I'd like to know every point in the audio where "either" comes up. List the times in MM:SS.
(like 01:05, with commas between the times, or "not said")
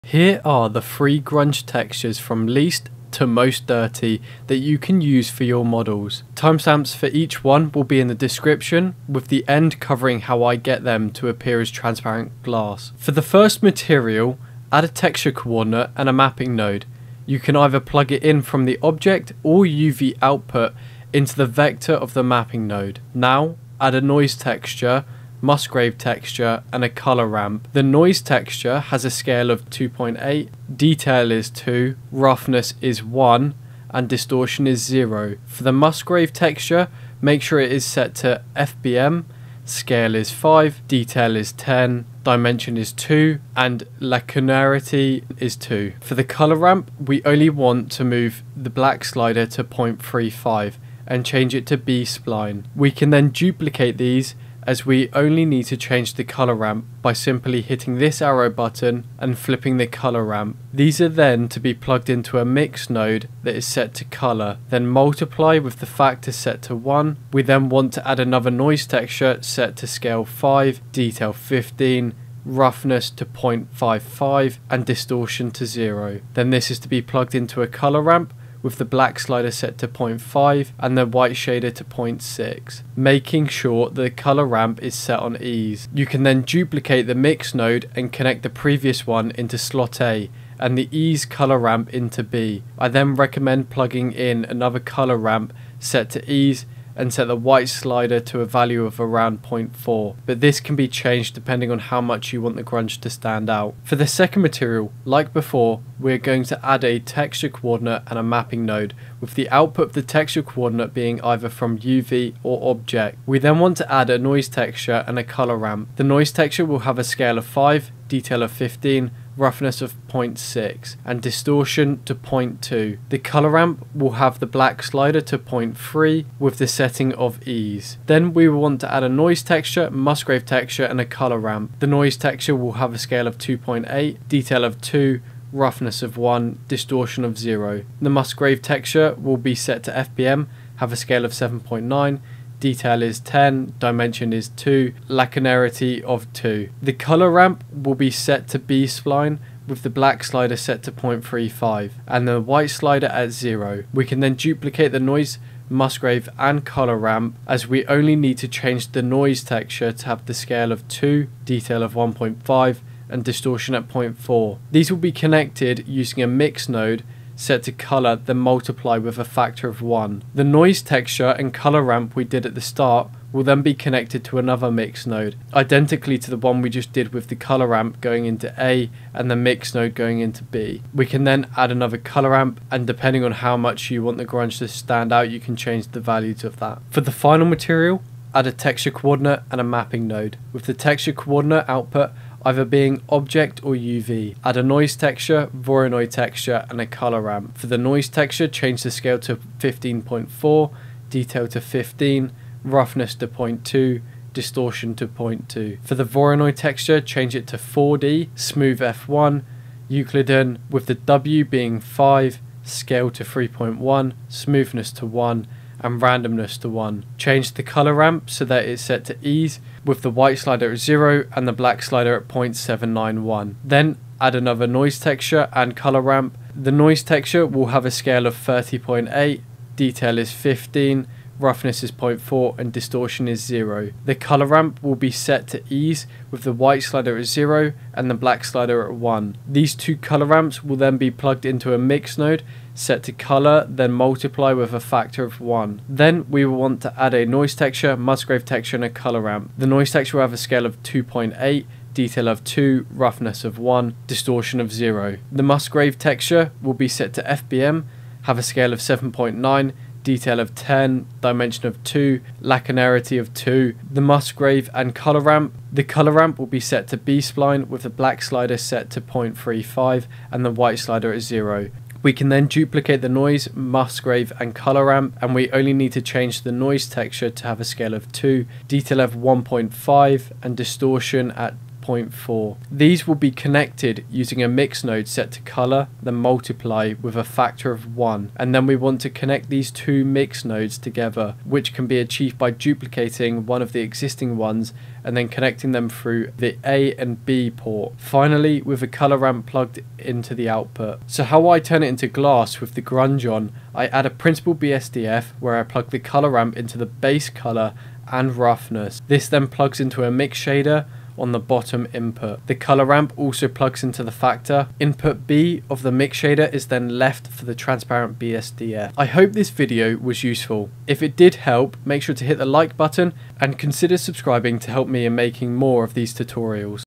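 00:17, 01:51, 03:12.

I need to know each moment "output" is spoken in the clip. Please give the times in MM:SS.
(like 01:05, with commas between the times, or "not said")
00:20, 01:49, 03:11, 05:00.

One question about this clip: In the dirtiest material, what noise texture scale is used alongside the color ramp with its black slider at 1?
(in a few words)
30.8.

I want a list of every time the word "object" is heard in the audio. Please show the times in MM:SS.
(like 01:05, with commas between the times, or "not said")
00:18, 01:52, 03:13.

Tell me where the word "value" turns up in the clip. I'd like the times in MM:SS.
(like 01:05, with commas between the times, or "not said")
01:38, 03:06.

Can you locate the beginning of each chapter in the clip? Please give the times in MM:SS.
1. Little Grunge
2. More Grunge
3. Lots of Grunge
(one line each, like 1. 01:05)
1. 00:14
2. 01:44
3. 03:07.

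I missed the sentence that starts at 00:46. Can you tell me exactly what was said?
For the color ramp, we only want to move the black slider to 0.35 and change it to B-spline.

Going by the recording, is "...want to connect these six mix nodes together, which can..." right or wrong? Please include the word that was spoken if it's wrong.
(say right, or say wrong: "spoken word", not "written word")
wrong: "two", not "six".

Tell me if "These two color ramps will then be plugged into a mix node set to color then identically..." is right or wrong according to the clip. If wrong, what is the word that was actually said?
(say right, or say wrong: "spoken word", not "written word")
wrong: "multiply", not "identically".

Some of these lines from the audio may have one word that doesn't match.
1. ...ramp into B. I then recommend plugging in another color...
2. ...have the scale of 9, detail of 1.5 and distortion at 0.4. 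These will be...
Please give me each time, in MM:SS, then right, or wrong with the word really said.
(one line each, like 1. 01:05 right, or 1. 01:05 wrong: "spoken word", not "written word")
1. 01:31 right
2. 02:40 wrong: "2", not "9".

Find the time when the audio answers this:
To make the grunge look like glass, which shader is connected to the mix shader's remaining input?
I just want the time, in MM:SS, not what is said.
05:17.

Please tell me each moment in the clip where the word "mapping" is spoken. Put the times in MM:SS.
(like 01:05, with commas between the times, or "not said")
00:16, 00:22, 01:48, 03:09.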